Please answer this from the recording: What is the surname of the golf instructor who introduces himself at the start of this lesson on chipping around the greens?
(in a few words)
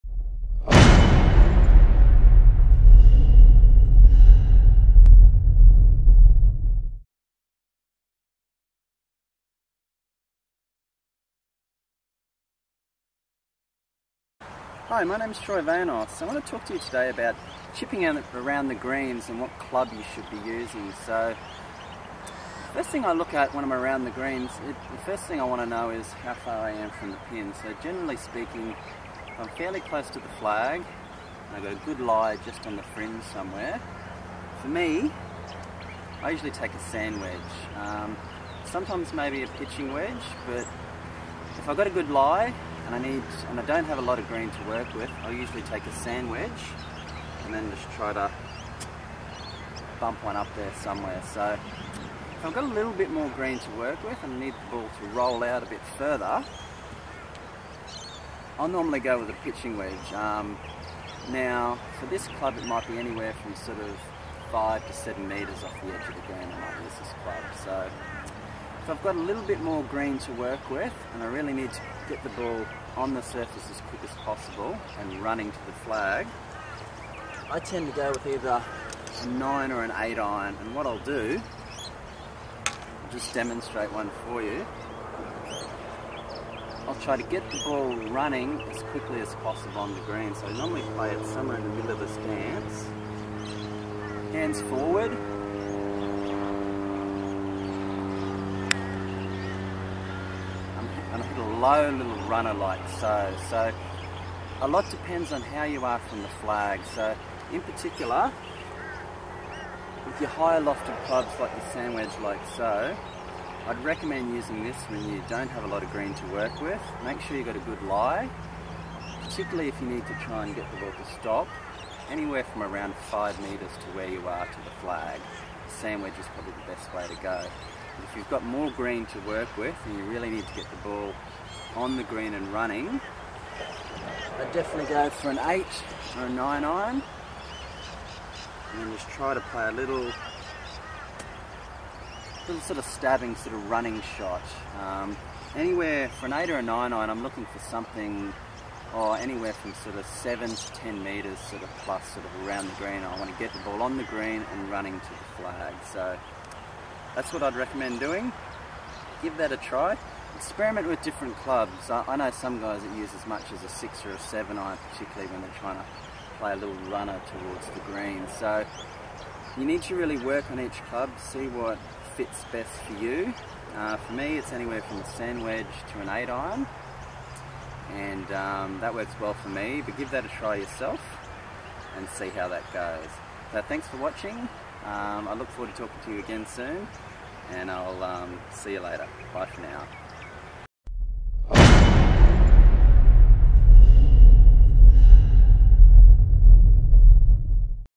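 Vanoss.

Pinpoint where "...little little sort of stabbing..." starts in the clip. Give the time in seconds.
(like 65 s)
139 s.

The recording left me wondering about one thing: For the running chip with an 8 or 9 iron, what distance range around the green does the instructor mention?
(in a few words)
7 to 10 metres.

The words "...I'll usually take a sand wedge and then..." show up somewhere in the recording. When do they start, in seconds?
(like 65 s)
45 s.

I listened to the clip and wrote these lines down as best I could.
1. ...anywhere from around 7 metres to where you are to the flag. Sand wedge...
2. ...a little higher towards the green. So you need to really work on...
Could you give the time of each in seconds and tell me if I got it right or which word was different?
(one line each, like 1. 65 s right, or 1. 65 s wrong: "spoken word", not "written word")
1. 122 s wrong: "5", not "7"
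2. 166 s wrong: "runner", not "higher".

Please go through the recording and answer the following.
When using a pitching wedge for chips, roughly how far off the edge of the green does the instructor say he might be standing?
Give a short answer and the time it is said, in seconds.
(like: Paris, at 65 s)
5 to 7 metres, at 64 s.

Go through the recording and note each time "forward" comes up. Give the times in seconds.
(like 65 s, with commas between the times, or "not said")
94 s, 185 s.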